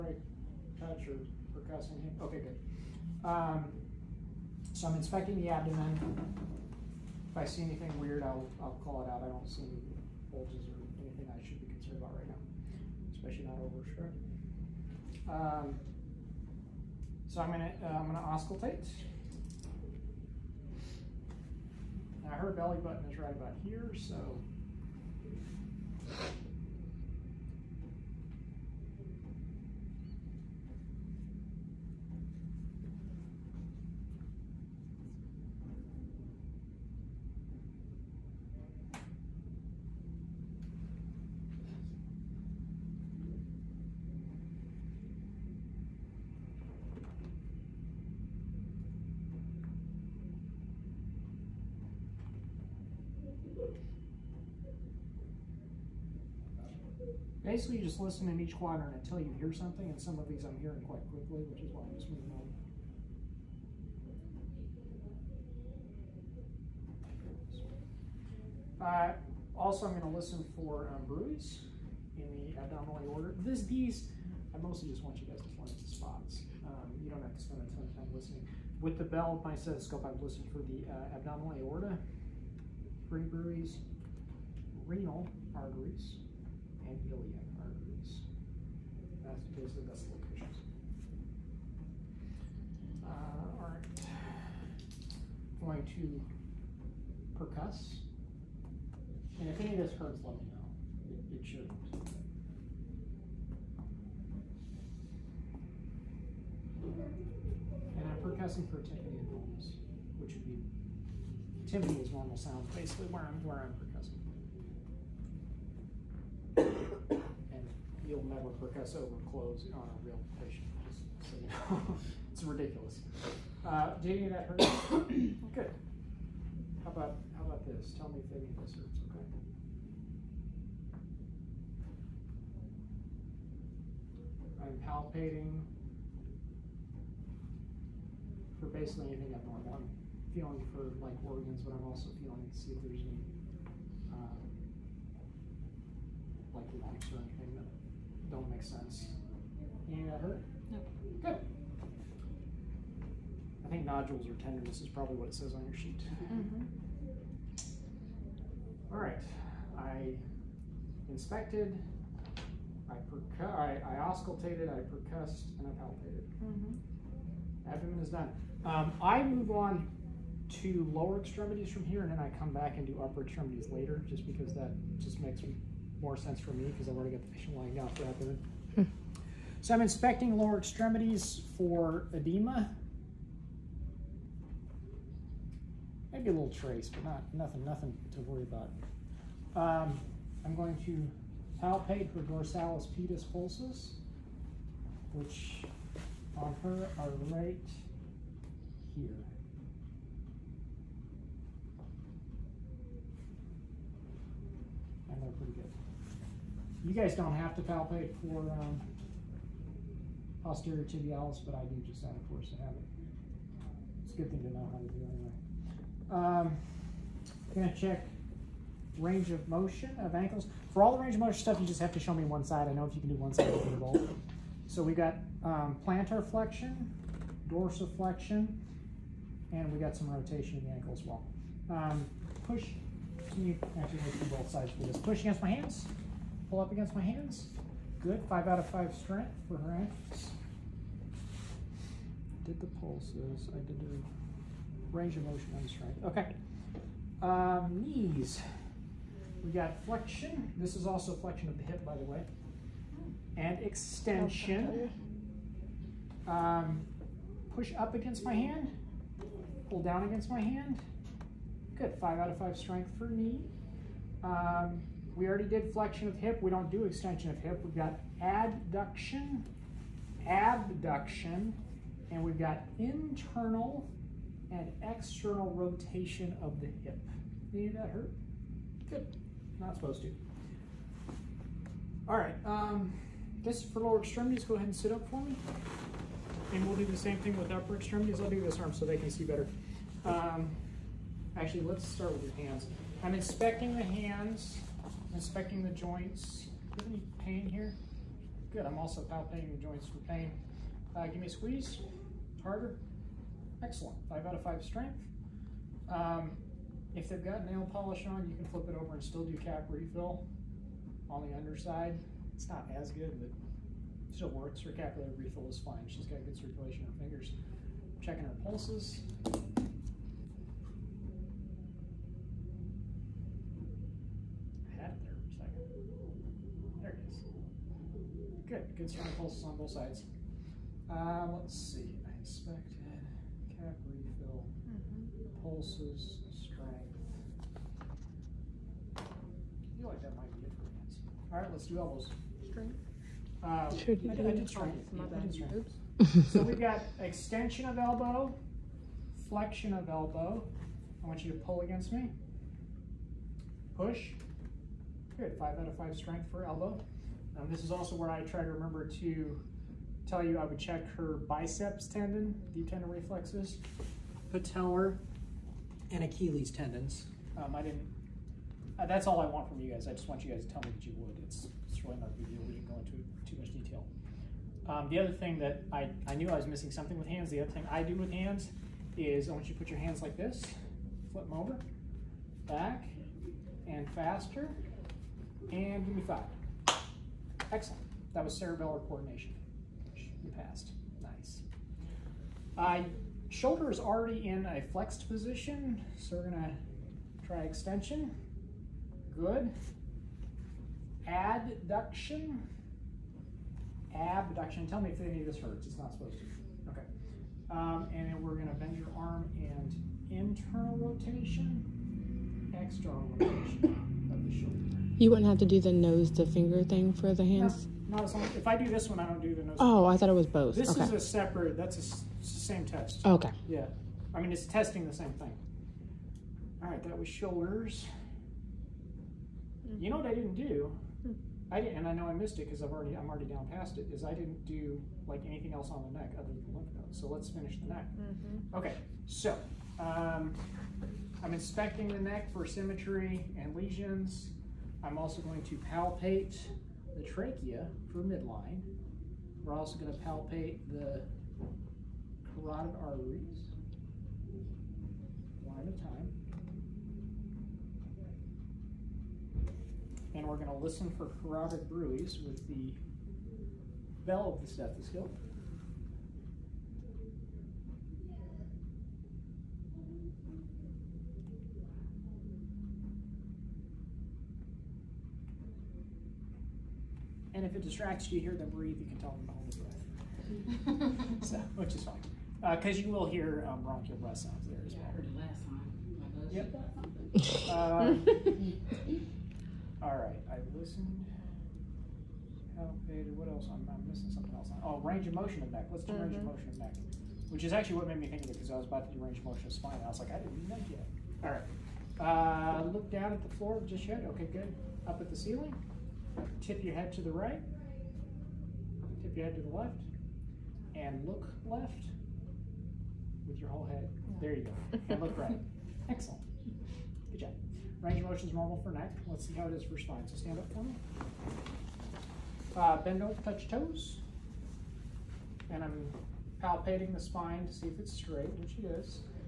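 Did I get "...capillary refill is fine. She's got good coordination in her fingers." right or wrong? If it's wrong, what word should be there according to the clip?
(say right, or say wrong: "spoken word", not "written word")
wrong: "circulation", not "coordination".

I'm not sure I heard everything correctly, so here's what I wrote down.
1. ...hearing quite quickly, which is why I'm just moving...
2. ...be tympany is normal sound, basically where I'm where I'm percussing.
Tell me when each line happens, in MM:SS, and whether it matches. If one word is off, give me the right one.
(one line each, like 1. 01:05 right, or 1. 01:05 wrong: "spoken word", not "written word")
1. 01:00 right
2. 01:50 right.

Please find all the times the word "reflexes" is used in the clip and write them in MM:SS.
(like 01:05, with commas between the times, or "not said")
06:02.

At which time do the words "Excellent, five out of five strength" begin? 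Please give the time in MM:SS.
05:03.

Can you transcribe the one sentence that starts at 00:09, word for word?
I don't see any bulges or anything I should be concerned about right now, especially not over sure.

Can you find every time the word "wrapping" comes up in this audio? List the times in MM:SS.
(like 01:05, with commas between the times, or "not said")
not said.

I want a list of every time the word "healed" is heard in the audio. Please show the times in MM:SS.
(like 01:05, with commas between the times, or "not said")
not said.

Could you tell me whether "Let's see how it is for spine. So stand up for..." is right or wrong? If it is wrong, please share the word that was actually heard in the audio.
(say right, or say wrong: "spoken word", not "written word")
right.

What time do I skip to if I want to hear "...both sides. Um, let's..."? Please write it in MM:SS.
05:29.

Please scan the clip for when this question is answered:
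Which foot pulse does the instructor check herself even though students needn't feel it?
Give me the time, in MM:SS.
03:30.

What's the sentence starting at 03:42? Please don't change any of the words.
I know if you can do one side, you can do both.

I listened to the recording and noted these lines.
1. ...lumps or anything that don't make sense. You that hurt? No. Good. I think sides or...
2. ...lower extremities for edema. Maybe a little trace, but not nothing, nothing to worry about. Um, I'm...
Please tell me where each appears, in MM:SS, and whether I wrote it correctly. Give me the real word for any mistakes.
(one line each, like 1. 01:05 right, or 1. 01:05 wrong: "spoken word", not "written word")
1. 02:26 wrong: "nodules", not "sides"
2. 03:00 right.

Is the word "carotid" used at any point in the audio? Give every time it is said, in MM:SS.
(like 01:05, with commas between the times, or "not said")
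07:32, 07:41.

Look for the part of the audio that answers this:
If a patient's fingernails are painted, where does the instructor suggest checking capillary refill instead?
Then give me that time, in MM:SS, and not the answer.
05:09.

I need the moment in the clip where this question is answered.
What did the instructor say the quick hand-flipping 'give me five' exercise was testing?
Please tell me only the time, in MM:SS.
06:28.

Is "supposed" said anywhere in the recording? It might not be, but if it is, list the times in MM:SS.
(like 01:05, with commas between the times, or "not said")
04:39, 06:45.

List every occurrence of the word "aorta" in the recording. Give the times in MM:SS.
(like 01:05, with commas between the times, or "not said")
01:13, 01:21.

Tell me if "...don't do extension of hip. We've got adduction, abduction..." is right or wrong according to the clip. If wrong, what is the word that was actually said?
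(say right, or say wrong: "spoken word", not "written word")
right.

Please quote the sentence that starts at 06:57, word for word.
No, as long if I do this one, I don't do the nose.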